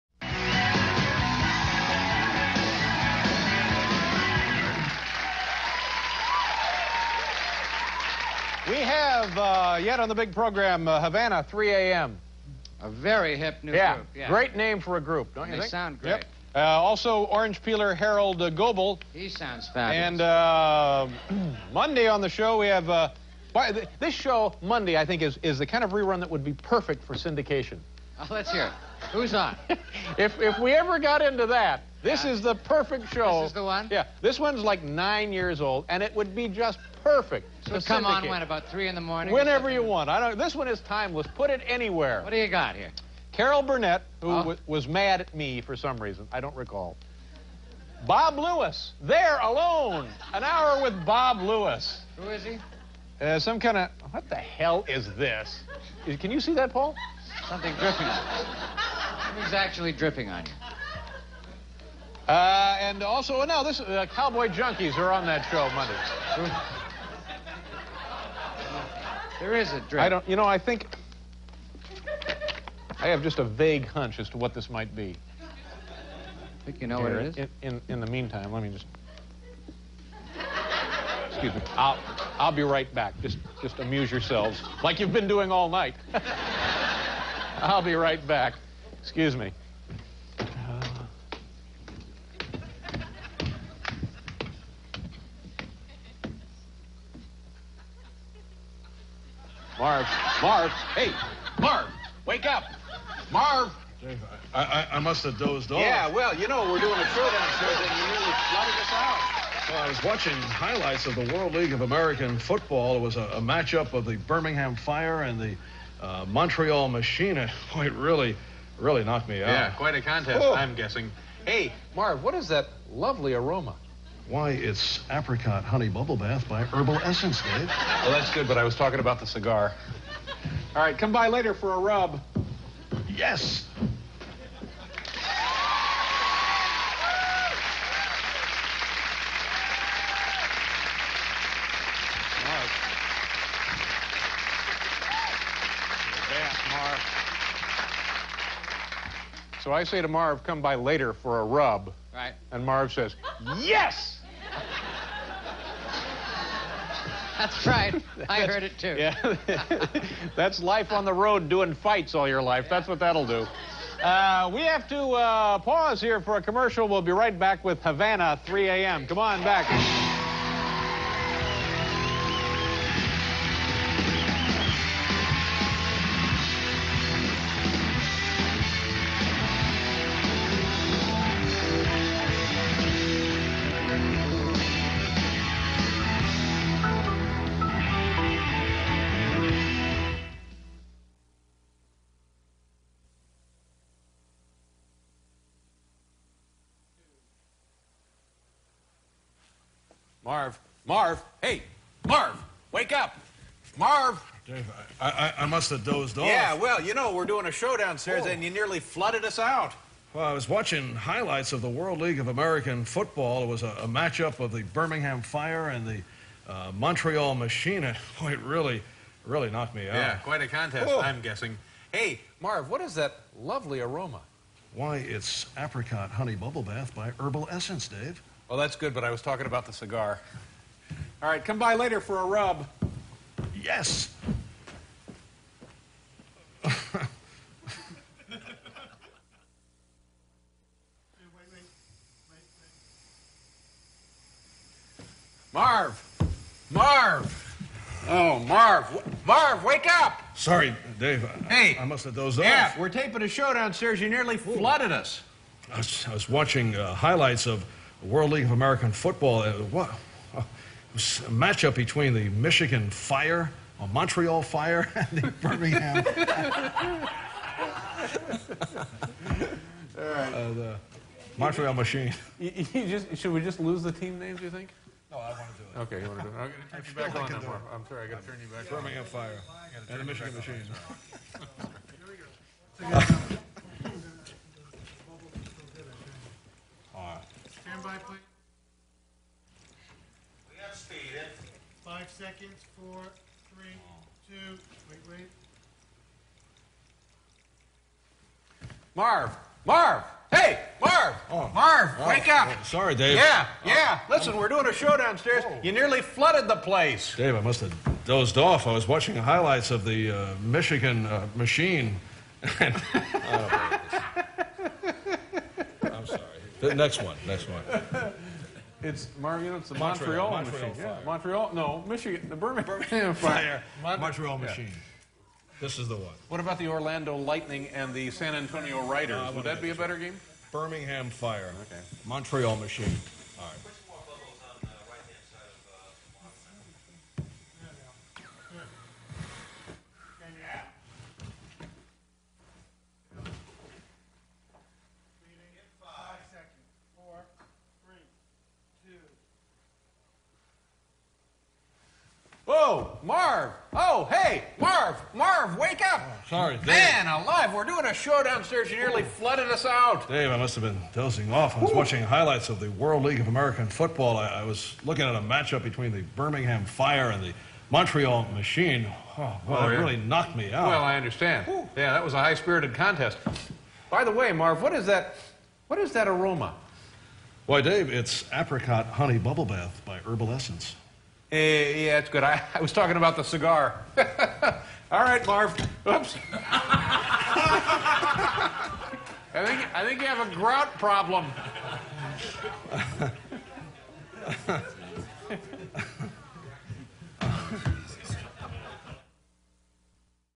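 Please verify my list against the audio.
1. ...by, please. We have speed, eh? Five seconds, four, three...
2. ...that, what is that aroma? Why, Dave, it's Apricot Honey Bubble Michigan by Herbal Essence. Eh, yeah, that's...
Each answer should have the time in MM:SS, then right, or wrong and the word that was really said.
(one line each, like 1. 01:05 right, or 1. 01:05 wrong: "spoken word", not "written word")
1. 04:47 right
2. 06:14 wrong: "Bath", not "Michigan".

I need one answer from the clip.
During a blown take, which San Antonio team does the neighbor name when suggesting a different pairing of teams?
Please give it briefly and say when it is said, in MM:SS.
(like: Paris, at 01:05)
San Antonio Riders, at 05:28.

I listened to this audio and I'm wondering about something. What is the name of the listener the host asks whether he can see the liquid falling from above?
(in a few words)
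Paul.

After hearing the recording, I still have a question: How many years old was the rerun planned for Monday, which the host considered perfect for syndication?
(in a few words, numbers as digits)
9.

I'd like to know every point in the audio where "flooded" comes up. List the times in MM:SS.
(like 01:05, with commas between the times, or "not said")
01:48, 03:28, 04:14, 05:06, 05:59.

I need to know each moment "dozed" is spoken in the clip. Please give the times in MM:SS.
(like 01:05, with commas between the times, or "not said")
01:45, 03:25, 04:12, 05:08.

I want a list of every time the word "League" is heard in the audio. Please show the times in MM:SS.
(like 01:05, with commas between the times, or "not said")
01:51, 03:32, 04:18, 06:03.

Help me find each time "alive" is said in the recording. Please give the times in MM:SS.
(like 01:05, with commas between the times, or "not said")
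05:57.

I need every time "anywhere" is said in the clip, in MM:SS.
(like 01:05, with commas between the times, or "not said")
00:41.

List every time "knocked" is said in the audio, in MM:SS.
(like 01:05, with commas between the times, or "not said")
01:59, 03:39, 06:09.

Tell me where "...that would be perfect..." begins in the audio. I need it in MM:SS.
00:26.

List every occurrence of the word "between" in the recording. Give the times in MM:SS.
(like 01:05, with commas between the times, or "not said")
04:21, 06:05.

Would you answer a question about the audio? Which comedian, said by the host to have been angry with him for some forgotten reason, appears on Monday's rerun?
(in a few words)
Carol Burnett.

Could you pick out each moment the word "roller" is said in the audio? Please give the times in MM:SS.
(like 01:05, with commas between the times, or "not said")
not said.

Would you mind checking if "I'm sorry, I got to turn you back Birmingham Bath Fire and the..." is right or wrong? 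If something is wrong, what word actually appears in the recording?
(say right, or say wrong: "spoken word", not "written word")
wrong: "Birmingham", not "Bath".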